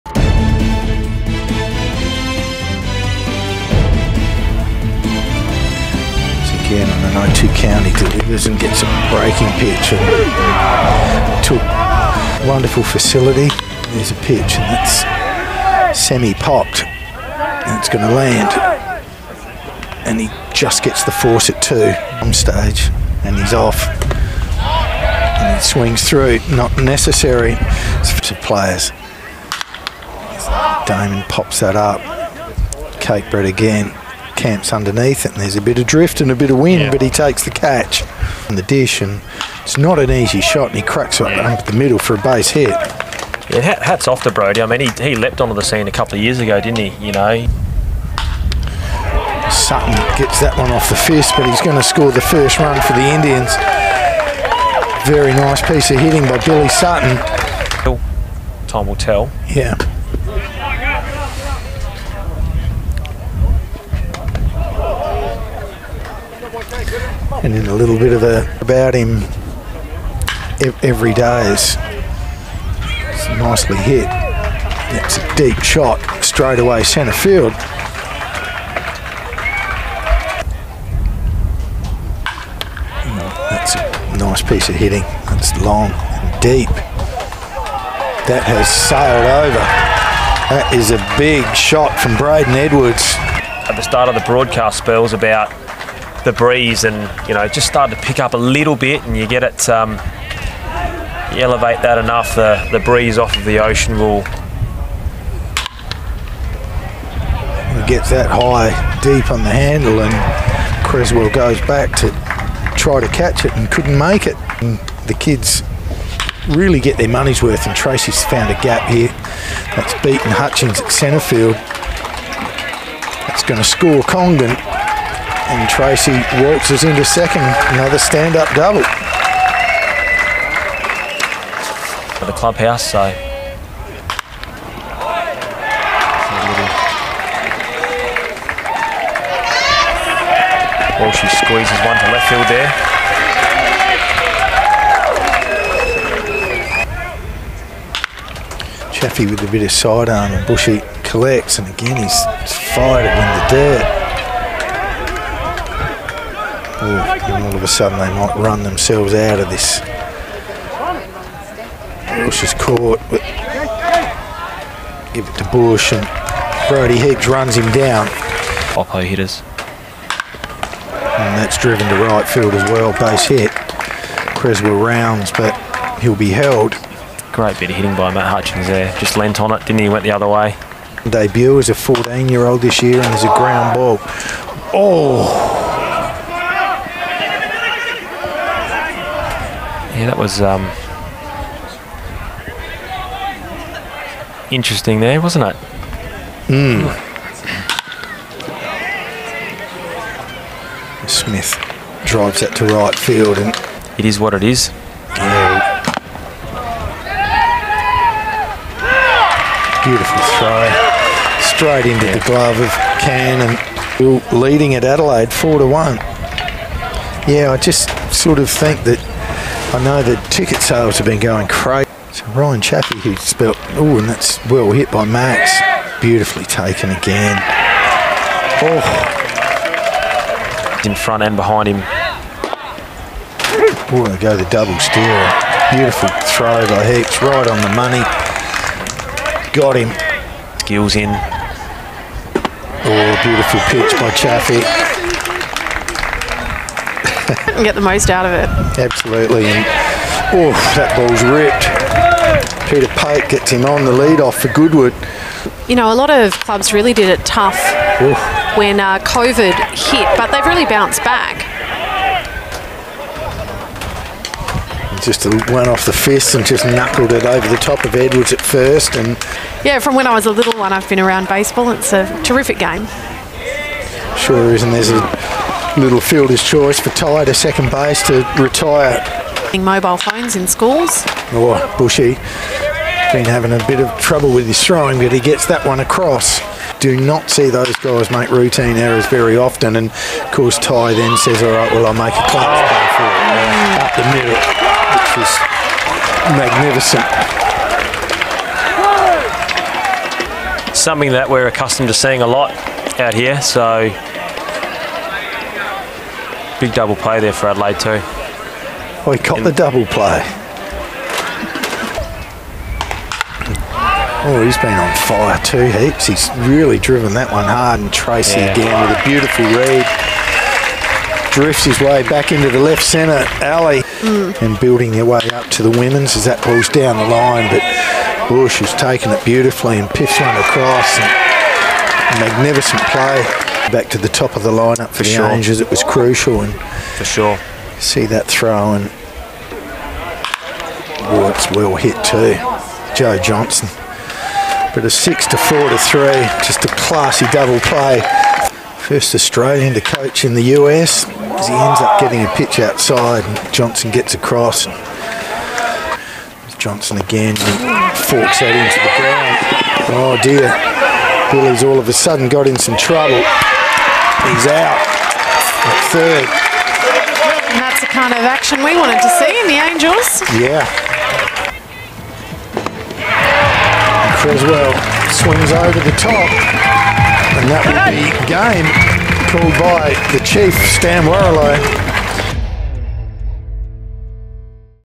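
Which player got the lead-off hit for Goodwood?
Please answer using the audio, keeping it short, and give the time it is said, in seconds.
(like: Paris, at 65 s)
Peter Pate, at 252 s.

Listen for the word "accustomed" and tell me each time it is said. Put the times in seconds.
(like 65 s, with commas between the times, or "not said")
301 s.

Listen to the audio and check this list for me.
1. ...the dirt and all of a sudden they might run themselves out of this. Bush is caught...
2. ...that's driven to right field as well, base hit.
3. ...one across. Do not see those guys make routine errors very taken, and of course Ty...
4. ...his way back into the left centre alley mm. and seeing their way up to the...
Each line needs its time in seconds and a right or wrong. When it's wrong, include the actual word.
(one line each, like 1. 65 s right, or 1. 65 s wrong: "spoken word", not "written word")
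1. 153 s right
2. 171 s right
3. 285 s wrong: "often", not "taken"
4. 321 s wrong: "building", not "seeing".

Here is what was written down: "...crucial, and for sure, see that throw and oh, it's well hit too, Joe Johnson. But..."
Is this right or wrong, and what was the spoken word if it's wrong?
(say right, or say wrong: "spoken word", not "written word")
right.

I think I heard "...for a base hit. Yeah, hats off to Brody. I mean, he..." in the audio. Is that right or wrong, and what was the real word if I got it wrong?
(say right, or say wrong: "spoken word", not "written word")
right.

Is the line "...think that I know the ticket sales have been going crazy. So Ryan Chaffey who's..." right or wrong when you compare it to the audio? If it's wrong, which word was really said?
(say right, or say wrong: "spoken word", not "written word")
right.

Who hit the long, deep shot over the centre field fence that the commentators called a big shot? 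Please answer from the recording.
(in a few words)
Braden Edwards.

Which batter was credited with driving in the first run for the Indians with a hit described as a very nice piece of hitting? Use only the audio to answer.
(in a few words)
Billy Sutton.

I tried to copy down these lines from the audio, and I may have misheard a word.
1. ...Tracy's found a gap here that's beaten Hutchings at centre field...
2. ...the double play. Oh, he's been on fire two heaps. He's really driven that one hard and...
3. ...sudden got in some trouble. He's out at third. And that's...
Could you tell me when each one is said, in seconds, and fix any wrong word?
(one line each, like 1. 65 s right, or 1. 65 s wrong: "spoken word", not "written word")
1. 117 s right
2. 309 s right
3. 361 s right.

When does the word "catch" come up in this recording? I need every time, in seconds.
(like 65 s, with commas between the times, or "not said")
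37 s, 113 s.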